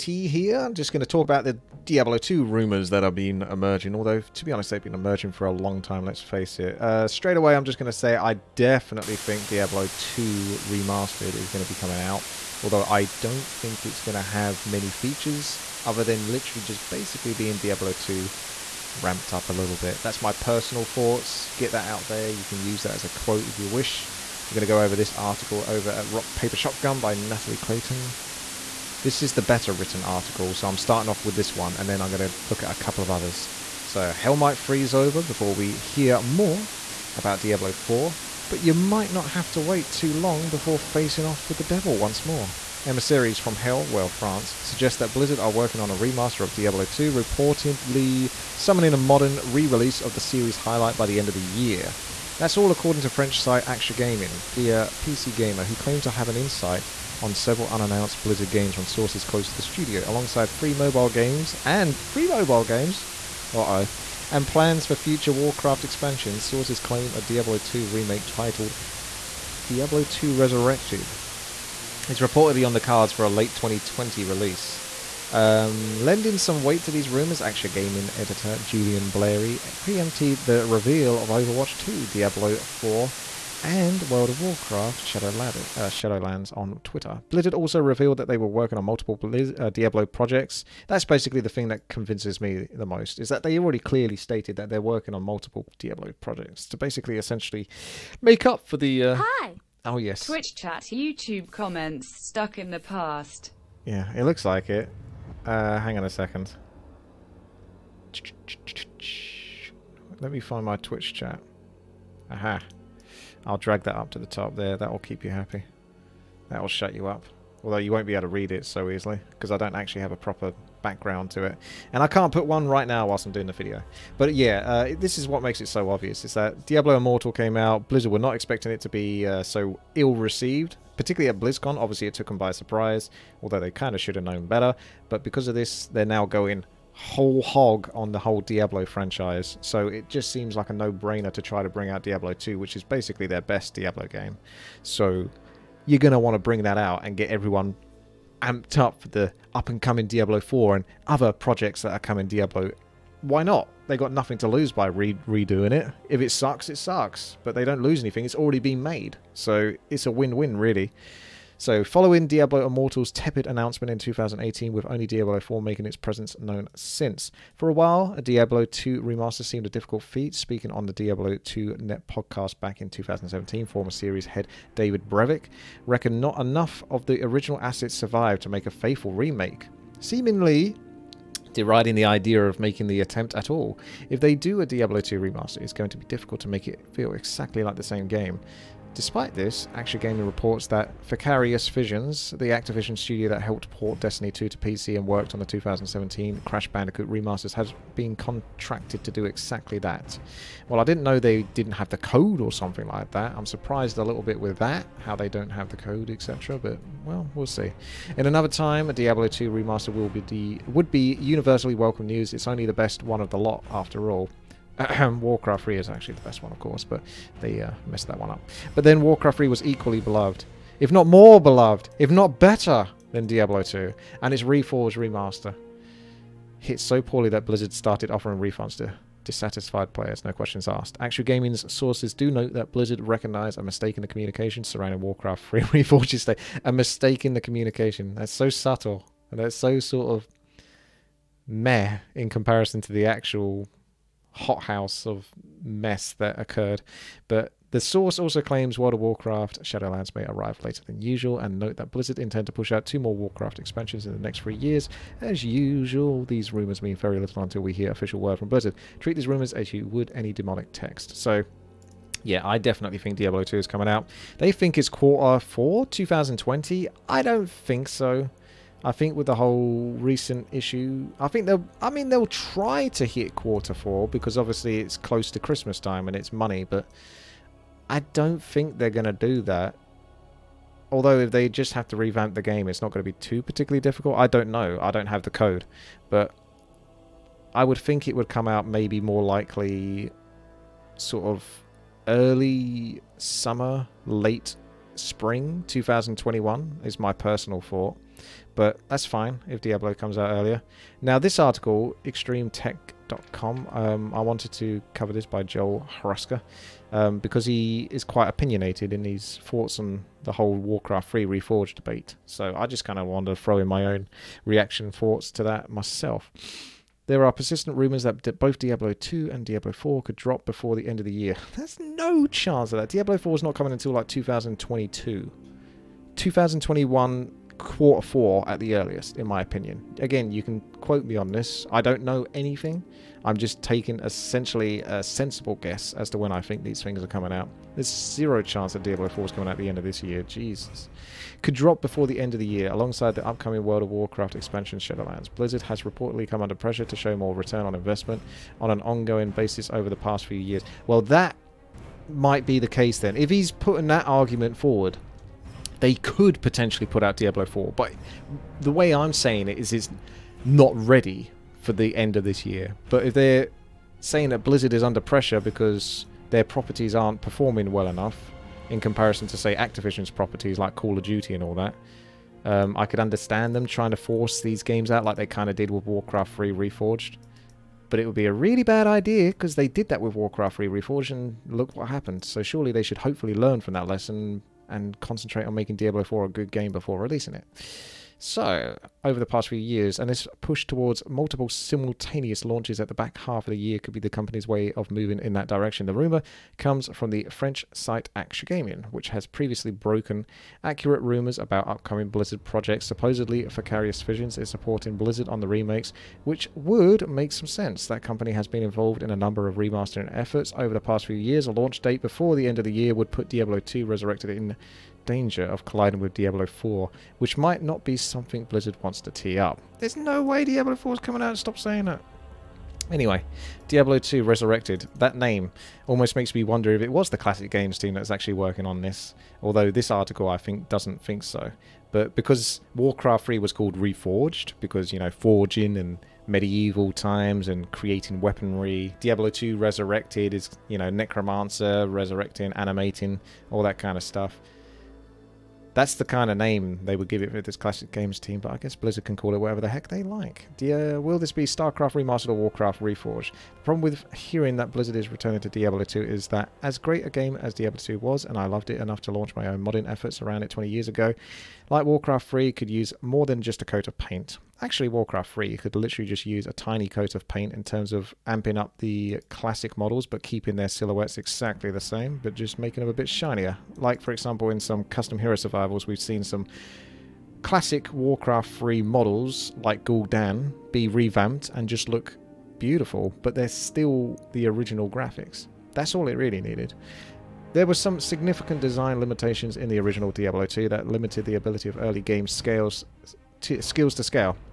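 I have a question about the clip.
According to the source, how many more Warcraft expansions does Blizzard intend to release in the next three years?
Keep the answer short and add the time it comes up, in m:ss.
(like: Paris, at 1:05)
2, at 4:12.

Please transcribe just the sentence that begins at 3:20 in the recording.
Well, I didn't know they didn't have the code or something like that.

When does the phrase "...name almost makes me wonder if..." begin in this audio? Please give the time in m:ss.
7:05.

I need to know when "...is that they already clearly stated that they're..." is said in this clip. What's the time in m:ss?
1:33.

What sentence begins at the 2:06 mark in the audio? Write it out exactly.
Is that Diablo Immortal came out.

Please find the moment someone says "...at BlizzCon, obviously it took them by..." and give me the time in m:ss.
2:11.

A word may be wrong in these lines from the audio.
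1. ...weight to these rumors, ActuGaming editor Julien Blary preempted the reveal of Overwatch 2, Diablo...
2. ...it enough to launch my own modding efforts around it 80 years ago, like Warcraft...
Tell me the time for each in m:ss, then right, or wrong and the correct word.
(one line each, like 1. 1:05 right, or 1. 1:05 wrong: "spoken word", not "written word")
1. 1:16 right
2. 7:38 wrong: "20", not "80".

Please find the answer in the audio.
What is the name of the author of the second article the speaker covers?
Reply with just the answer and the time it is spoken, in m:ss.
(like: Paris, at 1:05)
Joel Hruska, at 5:05.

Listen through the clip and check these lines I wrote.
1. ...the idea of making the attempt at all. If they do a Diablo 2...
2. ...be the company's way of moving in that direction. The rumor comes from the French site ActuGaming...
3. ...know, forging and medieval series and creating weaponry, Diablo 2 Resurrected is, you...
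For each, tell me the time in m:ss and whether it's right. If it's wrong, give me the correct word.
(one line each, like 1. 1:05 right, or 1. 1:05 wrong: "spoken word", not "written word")
1. 3:01 right
2. 6:33 right
3. 7:14 wrong: "times", not "series".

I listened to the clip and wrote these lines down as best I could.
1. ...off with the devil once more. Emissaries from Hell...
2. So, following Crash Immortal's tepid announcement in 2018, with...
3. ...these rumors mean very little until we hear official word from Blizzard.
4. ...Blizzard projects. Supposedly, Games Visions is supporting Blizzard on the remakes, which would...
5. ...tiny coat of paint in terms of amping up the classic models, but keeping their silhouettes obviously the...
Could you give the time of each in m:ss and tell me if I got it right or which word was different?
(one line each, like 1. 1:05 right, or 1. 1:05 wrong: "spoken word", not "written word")
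1. 0:41 right
2. 2:41 wrong: "Diablo", not "Crash"
3. 4:16 right
4. 6:42 wrong: "Vicarious", not "Games"
5. 7:46 wrong: "exactly", not "obviously".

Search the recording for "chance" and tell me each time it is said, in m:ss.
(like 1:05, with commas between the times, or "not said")
5:22, 5:38.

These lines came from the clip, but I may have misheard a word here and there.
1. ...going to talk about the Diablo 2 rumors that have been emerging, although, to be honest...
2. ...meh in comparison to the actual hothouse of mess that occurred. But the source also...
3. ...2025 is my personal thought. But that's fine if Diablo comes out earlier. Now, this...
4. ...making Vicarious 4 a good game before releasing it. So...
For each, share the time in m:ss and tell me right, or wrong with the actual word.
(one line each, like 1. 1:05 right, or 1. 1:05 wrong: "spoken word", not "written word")
1. 0:00 right
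2. 4:01 right
3. 4:55 wrong: "2021", not "2025"
4. 6:25 wrong: "Diablo", not "Vicarious".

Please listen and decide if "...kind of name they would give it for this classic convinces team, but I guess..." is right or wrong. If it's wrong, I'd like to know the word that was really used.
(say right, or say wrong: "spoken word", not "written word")
wrong: "games", not "convinces".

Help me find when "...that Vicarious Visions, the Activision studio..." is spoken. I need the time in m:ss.
3:10.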